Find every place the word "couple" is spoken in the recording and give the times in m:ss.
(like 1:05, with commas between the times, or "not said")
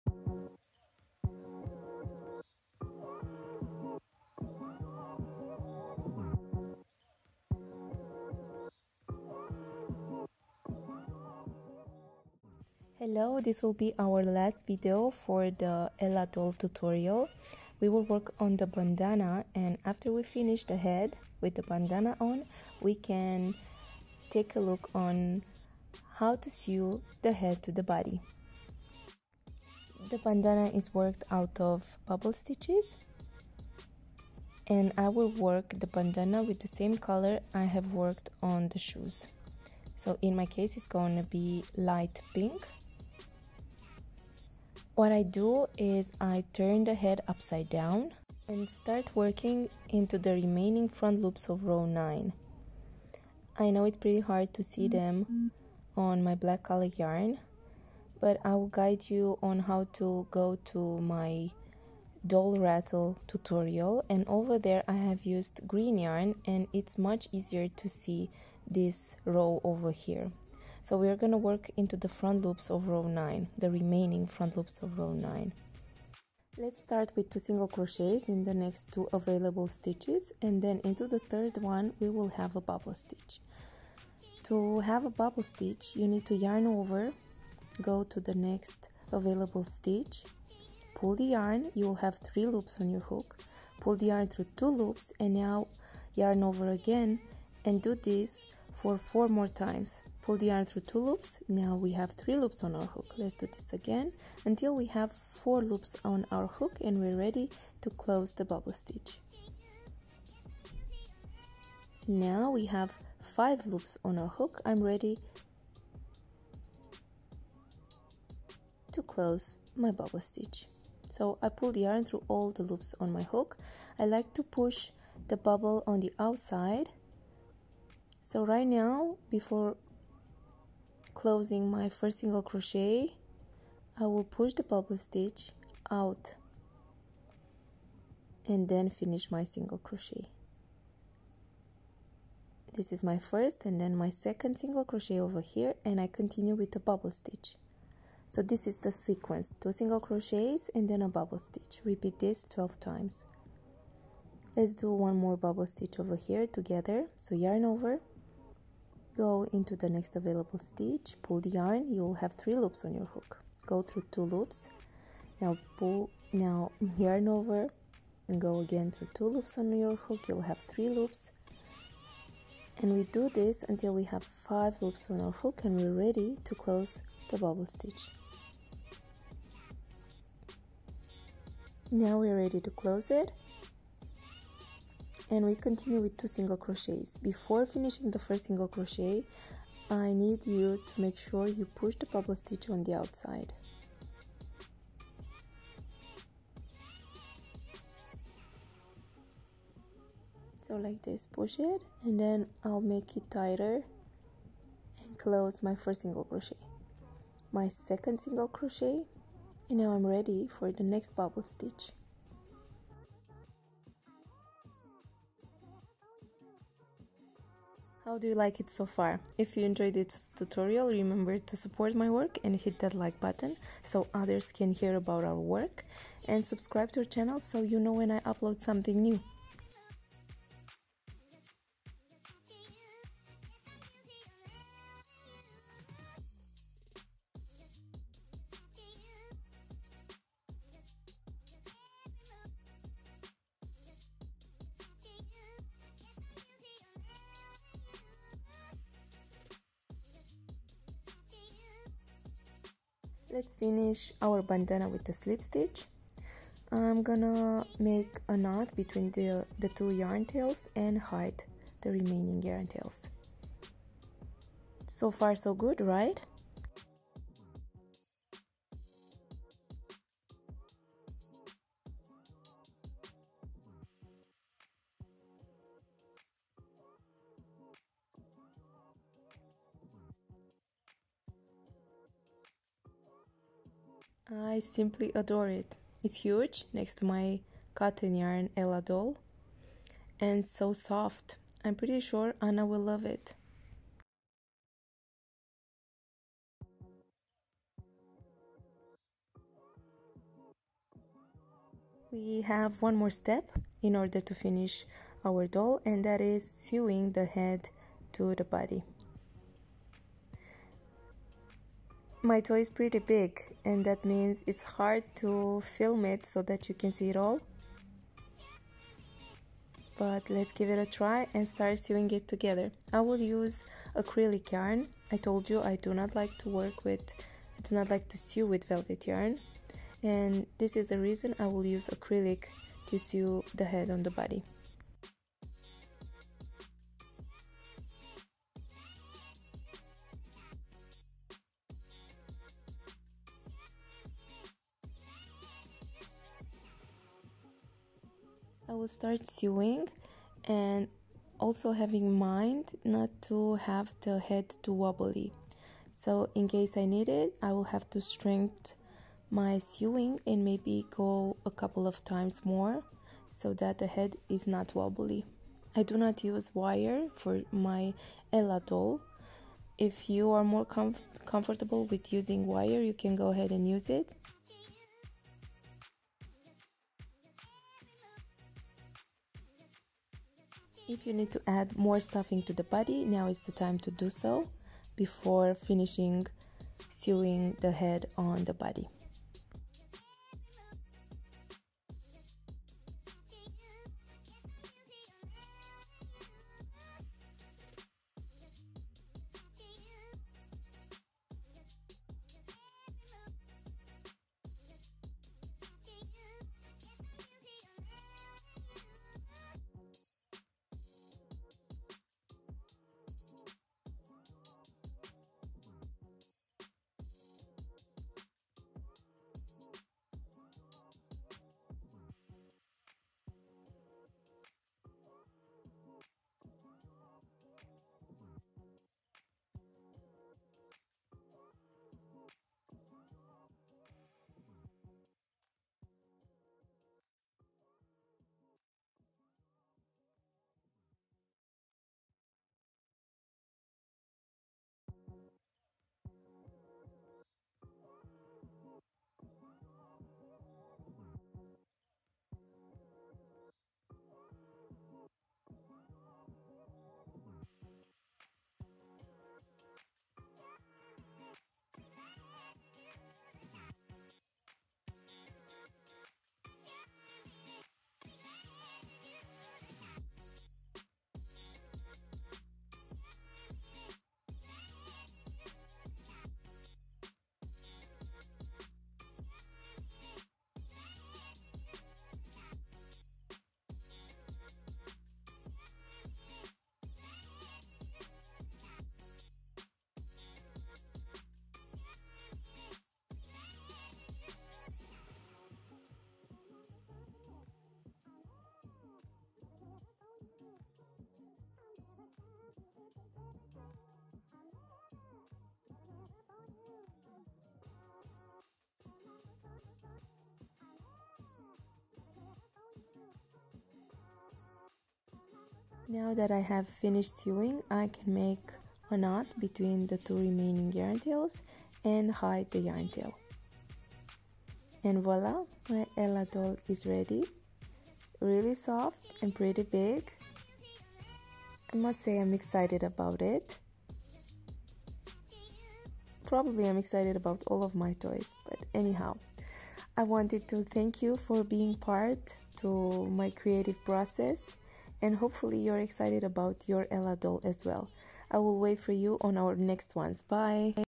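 6:01.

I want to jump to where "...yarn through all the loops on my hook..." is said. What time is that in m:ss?
2:01.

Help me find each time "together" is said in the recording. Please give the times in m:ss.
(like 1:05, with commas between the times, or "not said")
2:36, 5:22.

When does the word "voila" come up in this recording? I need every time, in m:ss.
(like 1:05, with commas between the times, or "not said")
8:45.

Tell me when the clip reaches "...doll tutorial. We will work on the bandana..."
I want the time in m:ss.
0:16.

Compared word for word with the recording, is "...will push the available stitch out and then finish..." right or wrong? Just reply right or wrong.
wrong.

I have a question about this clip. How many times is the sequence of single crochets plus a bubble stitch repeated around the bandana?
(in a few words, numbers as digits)
12.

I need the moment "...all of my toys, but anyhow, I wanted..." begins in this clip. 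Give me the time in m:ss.
8:57.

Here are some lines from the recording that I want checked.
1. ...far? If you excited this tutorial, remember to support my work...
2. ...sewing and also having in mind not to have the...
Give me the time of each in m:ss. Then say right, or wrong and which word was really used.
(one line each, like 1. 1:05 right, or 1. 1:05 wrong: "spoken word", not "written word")
1. 3:38 wrong: "enjoyed", not "excited"
2. 5:49 right.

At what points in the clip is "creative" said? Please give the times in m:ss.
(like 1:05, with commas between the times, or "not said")
9:03.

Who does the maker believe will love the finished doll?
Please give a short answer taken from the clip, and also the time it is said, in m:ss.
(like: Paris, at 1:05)
Anna, at 4:52.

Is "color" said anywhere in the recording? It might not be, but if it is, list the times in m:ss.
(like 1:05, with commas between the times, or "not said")
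0:36, 0:56.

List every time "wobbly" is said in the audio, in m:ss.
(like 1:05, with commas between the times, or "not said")
5:54, 6:04.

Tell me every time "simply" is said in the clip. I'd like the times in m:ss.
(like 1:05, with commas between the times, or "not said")
4:44.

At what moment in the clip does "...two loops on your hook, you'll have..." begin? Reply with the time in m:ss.
2:49.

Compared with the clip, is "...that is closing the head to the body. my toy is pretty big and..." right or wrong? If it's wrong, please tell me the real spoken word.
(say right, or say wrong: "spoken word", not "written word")
wrong: "sewing", not "closing".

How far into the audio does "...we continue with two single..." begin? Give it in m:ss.
3:05.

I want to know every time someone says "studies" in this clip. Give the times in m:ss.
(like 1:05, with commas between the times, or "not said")
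not said.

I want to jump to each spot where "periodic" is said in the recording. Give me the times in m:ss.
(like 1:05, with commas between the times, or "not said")
not said.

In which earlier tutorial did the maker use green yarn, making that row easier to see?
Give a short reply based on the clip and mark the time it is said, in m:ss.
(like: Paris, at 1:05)
doll rattle, at 1:02.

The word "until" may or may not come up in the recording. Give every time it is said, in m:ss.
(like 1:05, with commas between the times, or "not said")
1:44, 2:53.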